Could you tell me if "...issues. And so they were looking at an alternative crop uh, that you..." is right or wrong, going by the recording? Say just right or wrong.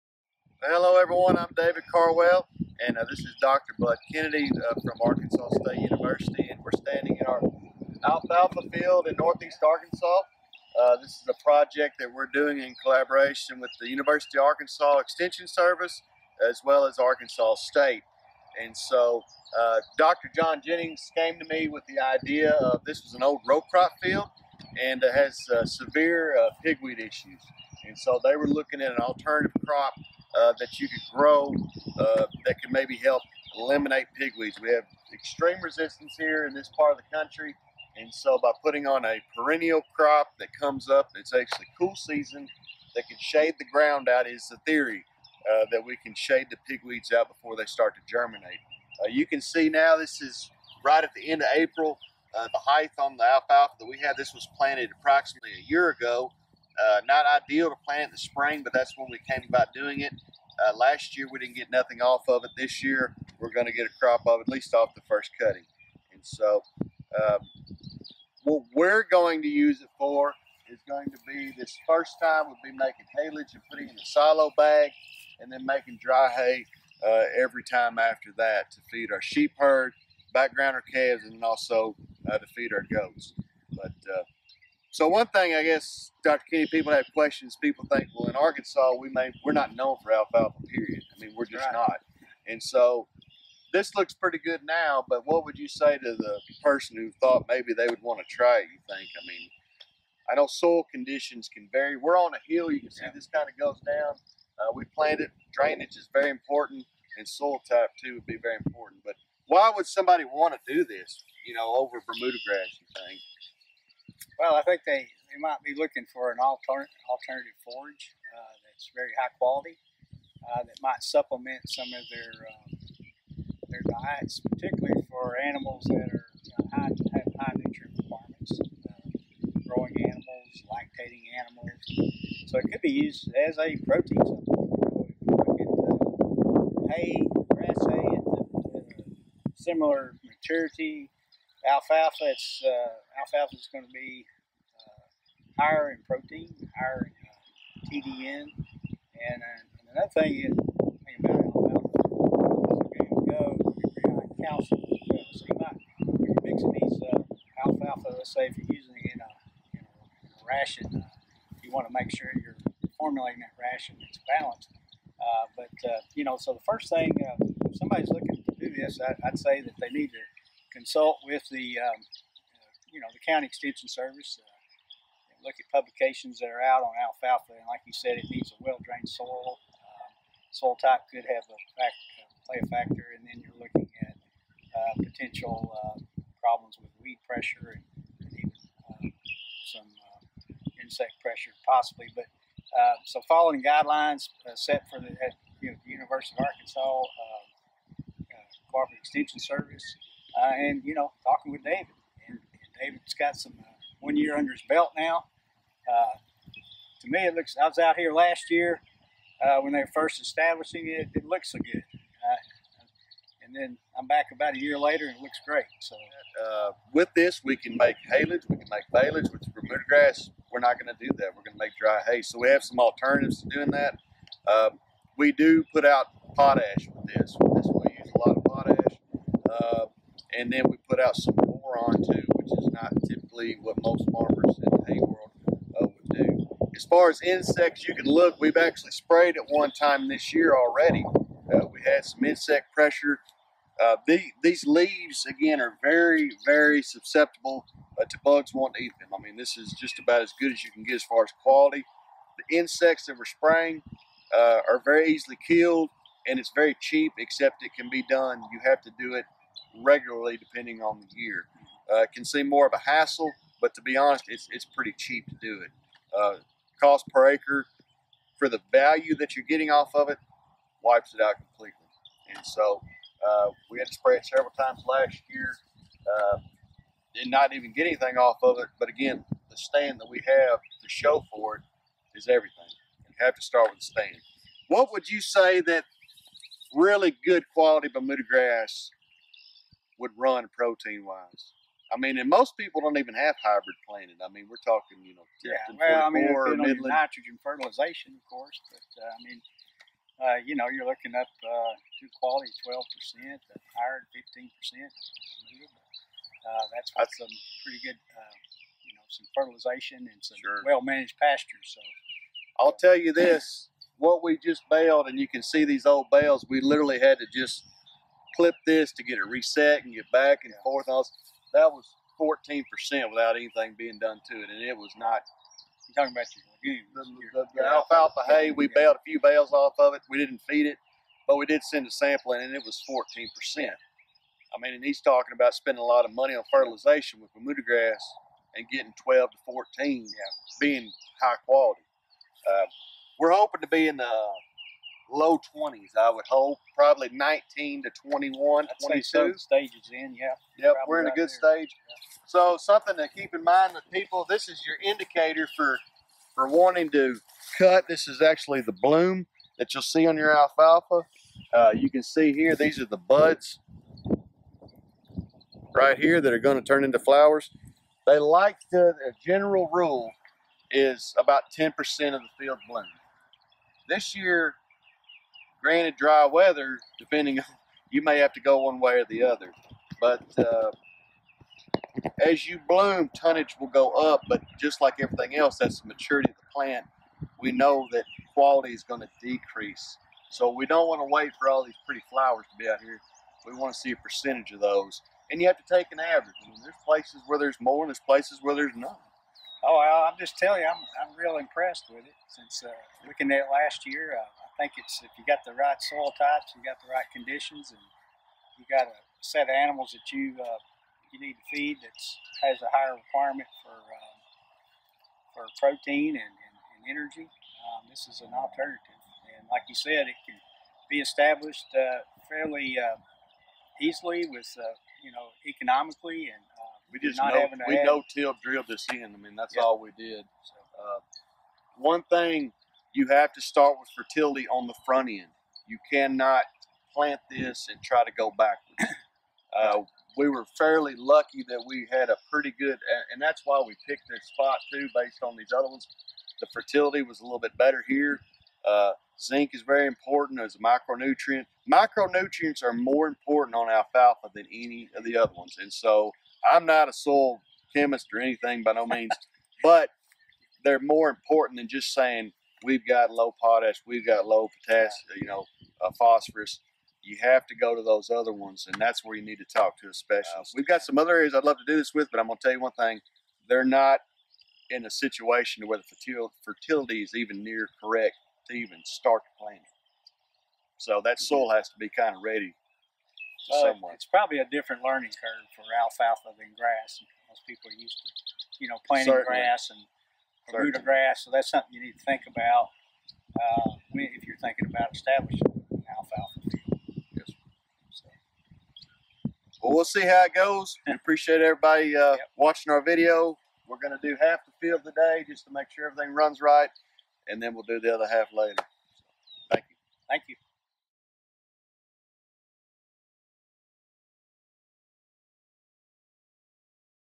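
right.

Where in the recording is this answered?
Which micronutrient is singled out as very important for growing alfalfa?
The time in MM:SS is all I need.
07:29.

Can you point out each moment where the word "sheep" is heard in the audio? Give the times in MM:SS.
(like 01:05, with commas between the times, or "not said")
01:19.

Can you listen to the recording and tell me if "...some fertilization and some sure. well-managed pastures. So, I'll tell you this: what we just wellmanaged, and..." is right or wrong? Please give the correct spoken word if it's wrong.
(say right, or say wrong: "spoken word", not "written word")
wrong: "baled", not "wellmanaged".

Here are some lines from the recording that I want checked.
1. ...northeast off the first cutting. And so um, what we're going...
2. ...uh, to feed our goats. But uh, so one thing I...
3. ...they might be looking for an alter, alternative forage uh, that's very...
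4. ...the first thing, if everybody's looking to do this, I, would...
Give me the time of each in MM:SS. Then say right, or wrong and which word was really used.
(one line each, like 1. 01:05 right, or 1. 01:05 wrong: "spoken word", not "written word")
1. 01:04 wrong: "least", not "northeast"
2. 01:22 right
3. 01:55 right
4. 02:46 wrong: "somebody", not "everybody".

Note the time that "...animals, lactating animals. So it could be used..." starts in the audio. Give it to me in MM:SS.
02:10.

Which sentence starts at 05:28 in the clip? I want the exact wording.
we baled a few bales off of it.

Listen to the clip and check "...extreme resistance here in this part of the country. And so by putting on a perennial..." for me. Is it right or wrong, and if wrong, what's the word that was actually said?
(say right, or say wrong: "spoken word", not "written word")
right.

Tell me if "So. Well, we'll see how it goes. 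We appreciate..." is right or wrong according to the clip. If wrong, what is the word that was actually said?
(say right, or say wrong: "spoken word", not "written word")
right.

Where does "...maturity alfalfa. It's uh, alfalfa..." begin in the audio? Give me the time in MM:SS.
02:20.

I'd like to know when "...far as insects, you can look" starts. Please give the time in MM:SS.
03:56.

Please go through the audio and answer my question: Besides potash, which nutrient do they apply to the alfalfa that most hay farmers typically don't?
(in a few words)
Boron.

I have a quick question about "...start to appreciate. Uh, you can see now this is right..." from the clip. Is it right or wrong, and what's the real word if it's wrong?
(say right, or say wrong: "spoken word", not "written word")
wrong: "germinate", not "appreciate".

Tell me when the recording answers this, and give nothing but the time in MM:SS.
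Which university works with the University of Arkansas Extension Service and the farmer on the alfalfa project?
00:05.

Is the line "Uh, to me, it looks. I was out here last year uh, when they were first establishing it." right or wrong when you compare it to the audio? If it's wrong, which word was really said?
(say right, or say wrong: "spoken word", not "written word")
right.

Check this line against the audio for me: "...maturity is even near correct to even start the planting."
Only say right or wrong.
wrong.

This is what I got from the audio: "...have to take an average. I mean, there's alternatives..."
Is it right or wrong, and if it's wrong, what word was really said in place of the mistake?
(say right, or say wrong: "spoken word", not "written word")
wrong: "places", not "alternatives".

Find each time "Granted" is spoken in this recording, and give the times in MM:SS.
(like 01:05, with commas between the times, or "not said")
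06:15.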